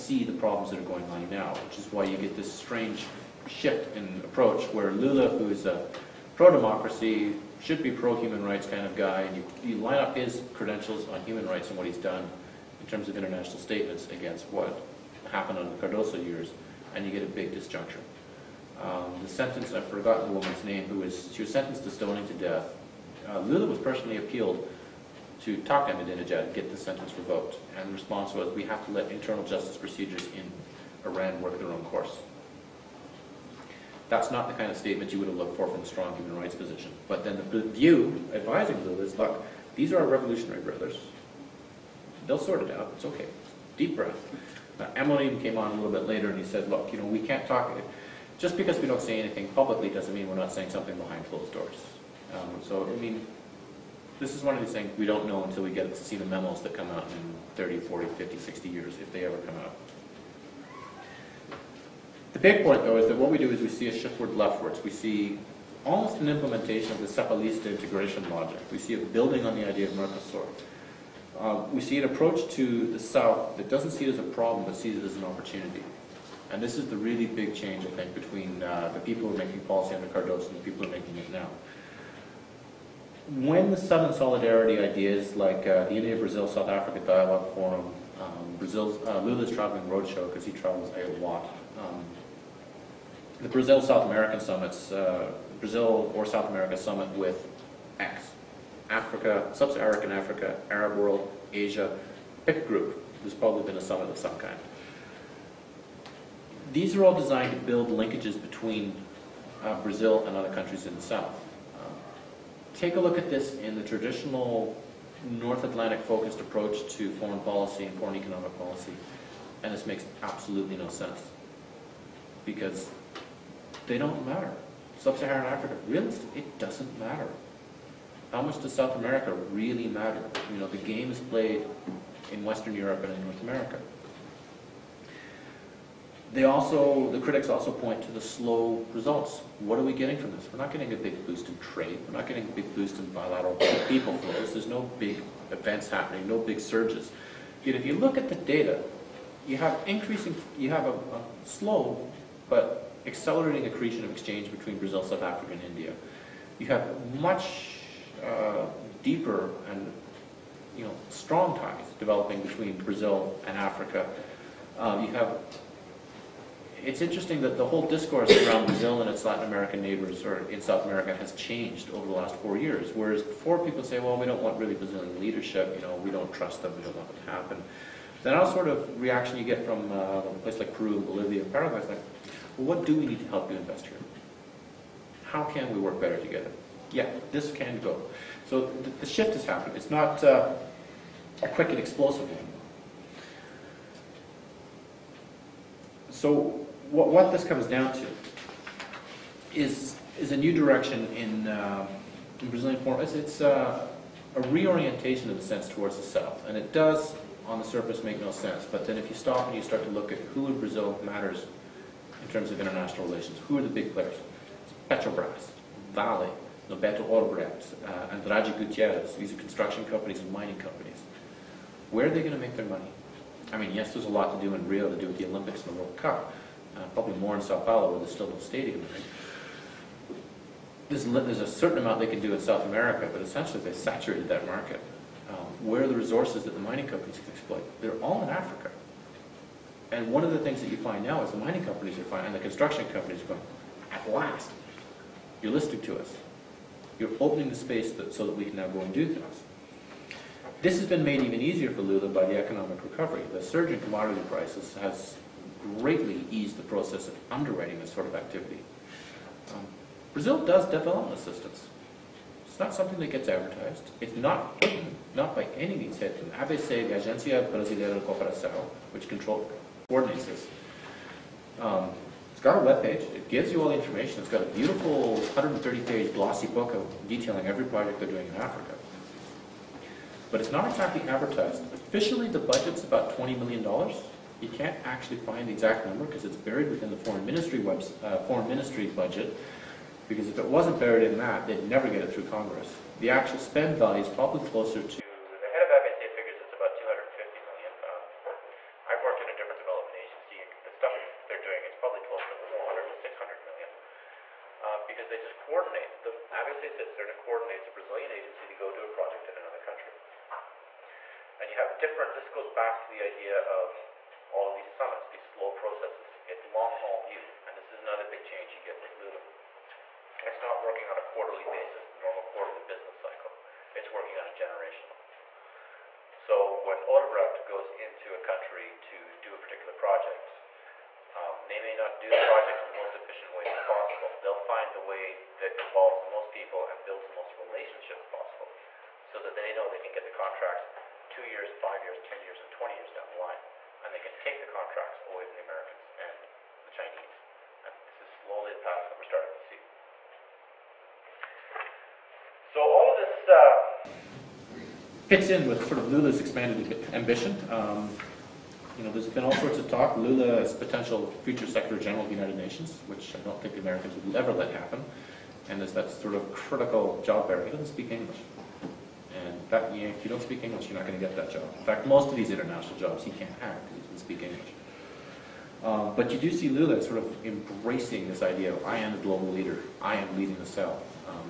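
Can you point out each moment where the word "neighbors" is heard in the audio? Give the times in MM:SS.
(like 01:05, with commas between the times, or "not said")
02:49.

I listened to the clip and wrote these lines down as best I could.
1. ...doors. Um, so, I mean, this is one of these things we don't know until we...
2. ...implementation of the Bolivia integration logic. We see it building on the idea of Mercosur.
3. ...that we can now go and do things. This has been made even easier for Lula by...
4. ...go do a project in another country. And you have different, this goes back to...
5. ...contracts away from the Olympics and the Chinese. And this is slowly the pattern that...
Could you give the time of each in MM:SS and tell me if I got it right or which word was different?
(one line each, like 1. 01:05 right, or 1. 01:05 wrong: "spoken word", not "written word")
1. 00:51 right
2. 01:06 wrong: "Cepalista", not "Bolivia"
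3. 04:08 right
4. 05:08 right
5. 05:44 wrong: "Americans", not "Olympics".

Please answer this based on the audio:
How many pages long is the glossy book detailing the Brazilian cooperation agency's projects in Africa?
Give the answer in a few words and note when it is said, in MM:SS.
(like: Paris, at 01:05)
130, at 04:35.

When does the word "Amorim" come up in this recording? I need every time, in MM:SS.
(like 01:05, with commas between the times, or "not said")
00:44.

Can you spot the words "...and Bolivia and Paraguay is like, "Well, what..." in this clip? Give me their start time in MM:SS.
03:00.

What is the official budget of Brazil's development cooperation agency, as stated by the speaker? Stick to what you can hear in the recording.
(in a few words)
$20 million.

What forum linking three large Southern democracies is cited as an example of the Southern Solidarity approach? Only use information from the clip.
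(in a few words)
India Brazil South Africa Dialogue Forum.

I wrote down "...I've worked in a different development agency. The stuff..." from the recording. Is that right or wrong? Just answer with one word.
right.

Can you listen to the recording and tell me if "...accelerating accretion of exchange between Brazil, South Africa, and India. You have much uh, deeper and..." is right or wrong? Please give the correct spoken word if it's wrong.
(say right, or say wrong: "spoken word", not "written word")
right.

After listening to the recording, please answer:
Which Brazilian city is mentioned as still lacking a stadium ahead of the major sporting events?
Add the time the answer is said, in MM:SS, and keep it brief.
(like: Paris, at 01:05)
Sao Paulo, at 03:47.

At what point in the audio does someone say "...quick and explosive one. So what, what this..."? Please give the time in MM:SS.
03:11.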